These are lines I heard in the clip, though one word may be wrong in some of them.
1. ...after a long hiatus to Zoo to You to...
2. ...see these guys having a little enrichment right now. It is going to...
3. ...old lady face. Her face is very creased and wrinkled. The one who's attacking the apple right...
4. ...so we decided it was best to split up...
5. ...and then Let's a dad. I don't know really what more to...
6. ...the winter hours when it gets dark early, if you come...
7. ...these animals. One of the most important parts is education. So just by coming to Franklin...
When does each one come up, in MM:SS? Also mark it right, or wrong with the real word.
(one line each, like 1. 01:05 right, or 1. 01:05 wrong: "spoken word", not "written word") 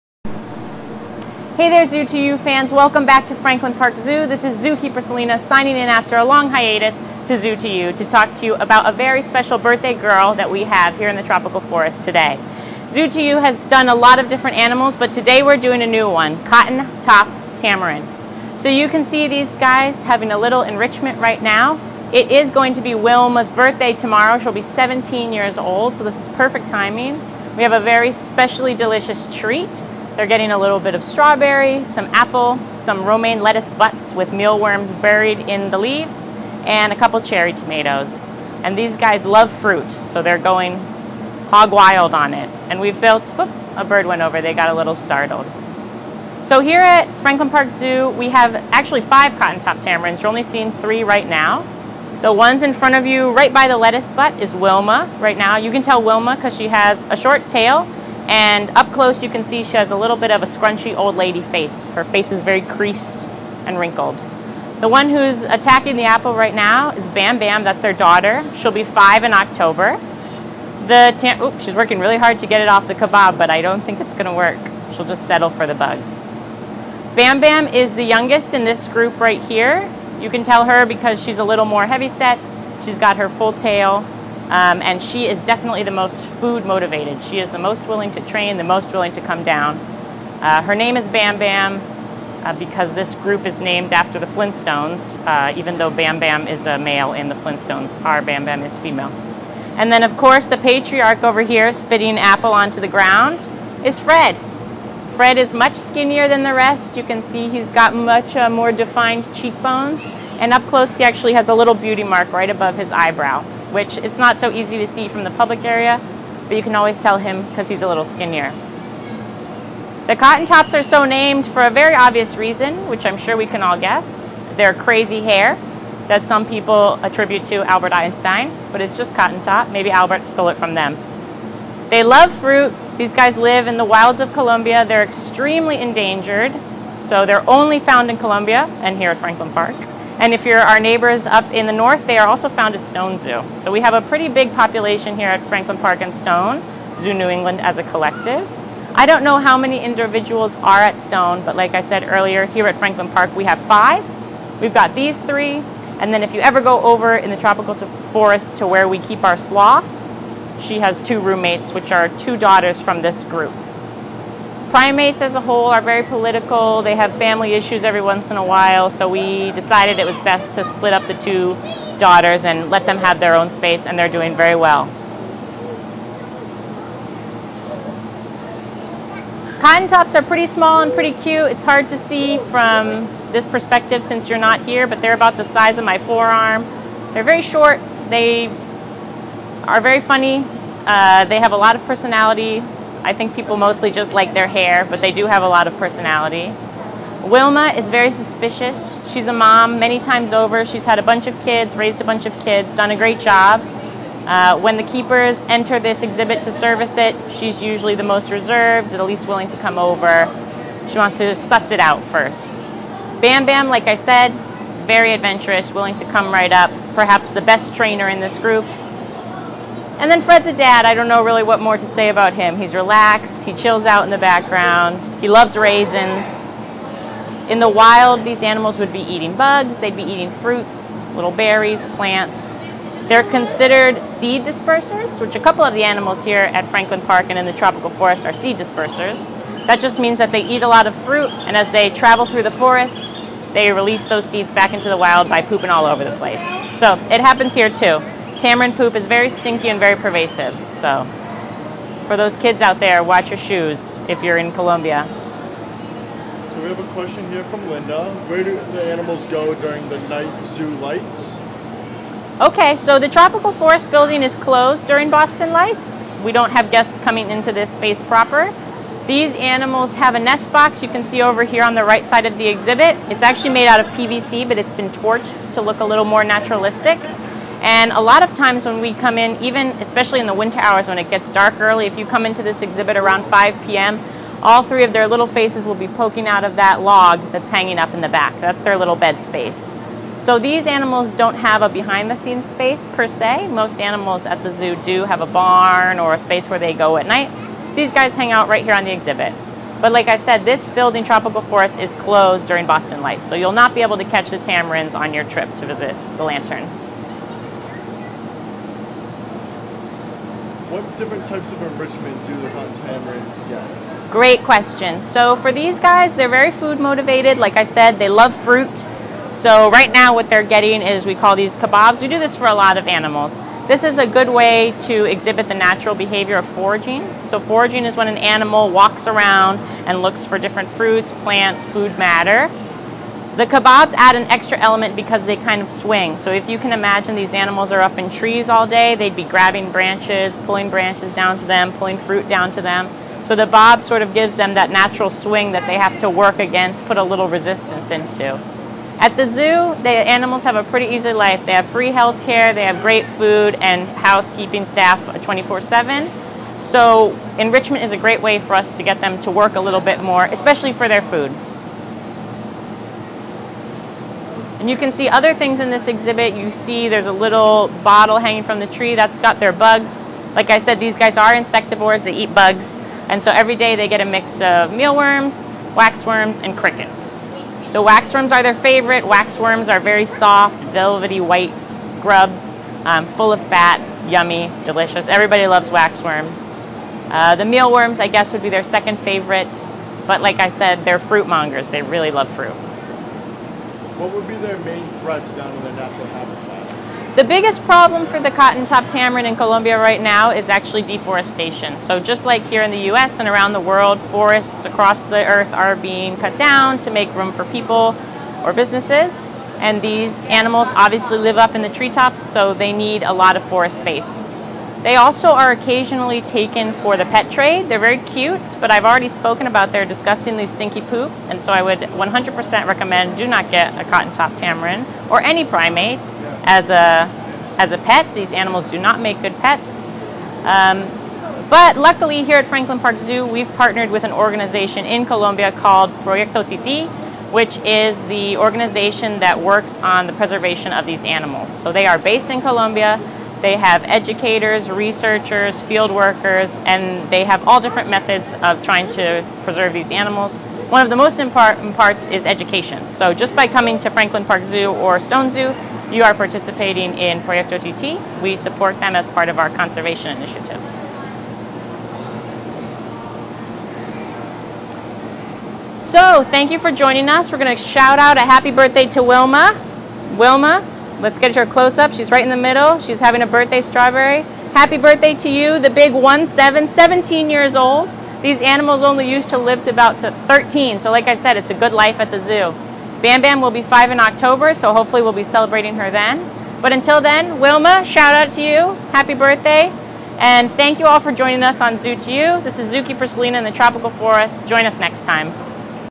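1. 00:05 right
2. 00:19 right
3. 01:00 right
4. 02:48 right
5. 03:40 wrong: "Fred", not "Let"
6. 04:40 right
7. 07:29 right.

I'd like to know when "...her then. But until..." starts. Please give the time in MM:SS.
08:05.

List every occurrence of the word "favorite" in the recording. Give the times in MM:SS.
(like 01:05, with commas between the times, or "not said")
06:18, 06:28.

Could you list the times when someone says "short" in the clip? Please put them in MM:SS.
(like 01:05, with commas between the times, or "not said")
00:57, 03:07.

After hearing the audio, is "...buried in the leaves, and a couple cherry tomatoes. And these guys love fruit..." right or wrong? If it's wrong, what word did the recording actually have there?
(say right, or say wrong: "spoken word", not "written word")
right.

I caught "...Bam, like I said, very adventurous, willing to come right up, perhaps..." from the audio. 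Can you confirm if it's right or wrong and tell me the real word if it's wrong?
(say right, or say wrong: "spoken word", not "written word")
right.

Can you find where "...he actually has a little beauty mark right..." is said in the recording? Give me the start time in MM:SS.
01:50.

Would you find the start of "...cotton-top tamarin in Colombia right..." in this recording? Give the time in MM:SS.
06:38.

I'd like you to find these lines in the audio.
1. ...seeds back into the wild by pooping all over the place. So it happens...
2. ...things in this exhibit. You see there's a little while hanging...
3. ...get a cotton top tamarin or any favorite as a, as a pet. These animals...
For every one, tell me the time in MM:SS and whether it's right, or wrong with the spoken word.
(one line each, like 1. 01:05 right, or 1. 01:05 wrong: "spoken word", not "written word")
1. 04:04 right
2. 06:05 wrong: "bottle", not "while"
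3. 07:03 wrong: "primate", not "favorite".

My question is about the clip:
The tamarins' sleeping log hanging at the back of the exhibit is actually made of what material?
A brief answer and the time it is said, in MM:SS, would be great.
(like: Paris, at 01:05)
PVC, at 04:33.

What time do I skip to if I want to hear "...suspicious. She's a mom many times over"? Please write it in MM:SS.
03:18.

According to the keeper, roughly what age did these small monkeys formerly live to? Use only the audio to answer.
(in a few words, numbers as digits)
13.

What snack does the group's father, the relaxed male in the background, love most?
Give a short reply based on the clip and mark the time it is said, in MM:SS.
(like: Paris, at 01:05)
Raisins, at 03:45.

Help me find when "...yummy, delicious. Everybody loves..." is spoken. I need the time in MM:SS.
06:24.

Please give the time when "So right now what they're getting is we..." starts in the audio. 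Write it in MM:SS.
05:19.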